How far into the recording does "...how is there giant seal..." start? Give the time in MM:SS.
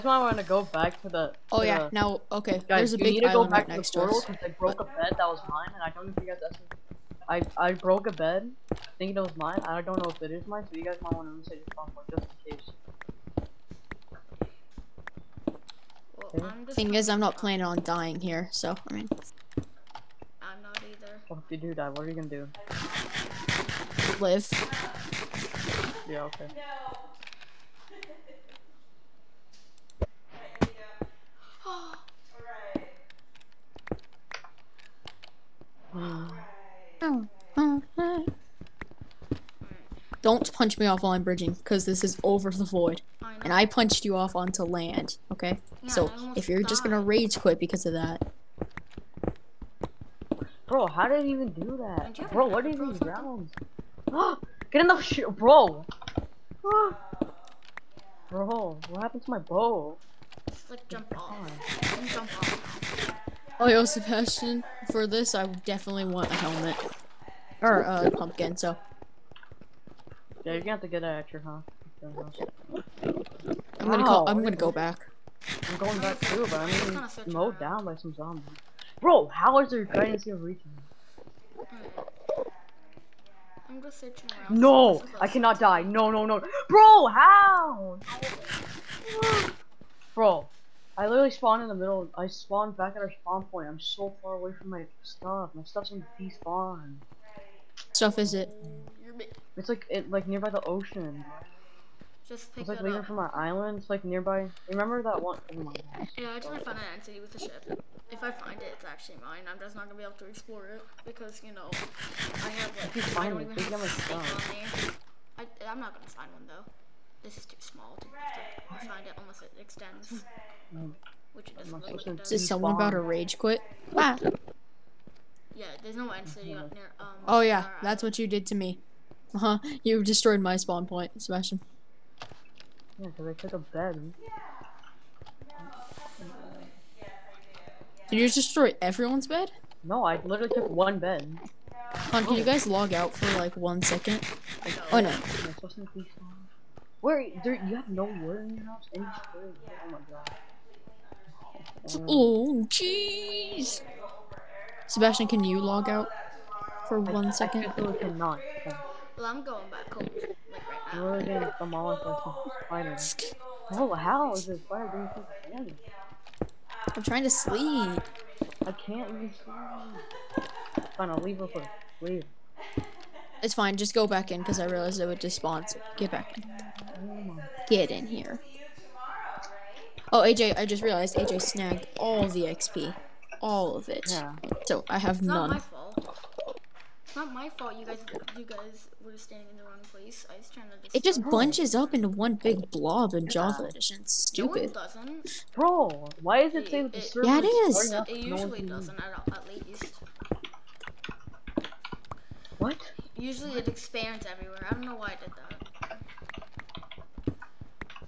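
01:19.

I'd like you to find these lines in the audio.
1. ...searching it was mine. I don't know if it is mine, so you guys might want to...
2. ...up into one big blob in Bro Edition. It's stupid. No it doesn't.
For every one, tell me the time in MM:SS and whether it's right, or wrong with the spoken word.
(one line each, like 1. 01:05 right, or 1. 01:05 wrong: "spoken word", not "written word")
1. 00:08 wrong: "thinking", not "searching"
2. 03:11 wrong: "Java", not "Bro".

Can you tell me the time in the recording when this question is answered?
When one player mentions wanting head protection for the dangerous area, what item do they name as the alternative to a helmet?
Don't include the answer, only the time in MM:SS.
01:08.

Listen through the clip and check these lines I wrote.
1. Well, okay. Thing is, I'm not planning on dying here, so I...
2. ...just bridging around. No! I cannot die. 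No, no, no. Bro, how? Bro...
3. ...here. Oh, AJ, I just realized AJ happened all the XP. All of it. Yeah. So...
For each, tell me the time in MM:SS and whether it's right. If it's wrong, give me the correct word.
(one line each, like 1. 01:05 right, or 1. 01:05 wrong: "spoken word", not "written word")
1. 00:16 right
2. 01:23 wrong: "searching", not "bridging"
3. 02:58 wrong: "snagged", not "happened".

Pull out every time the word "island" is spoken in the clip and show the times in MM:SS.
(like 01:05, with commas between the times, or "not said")
01:43.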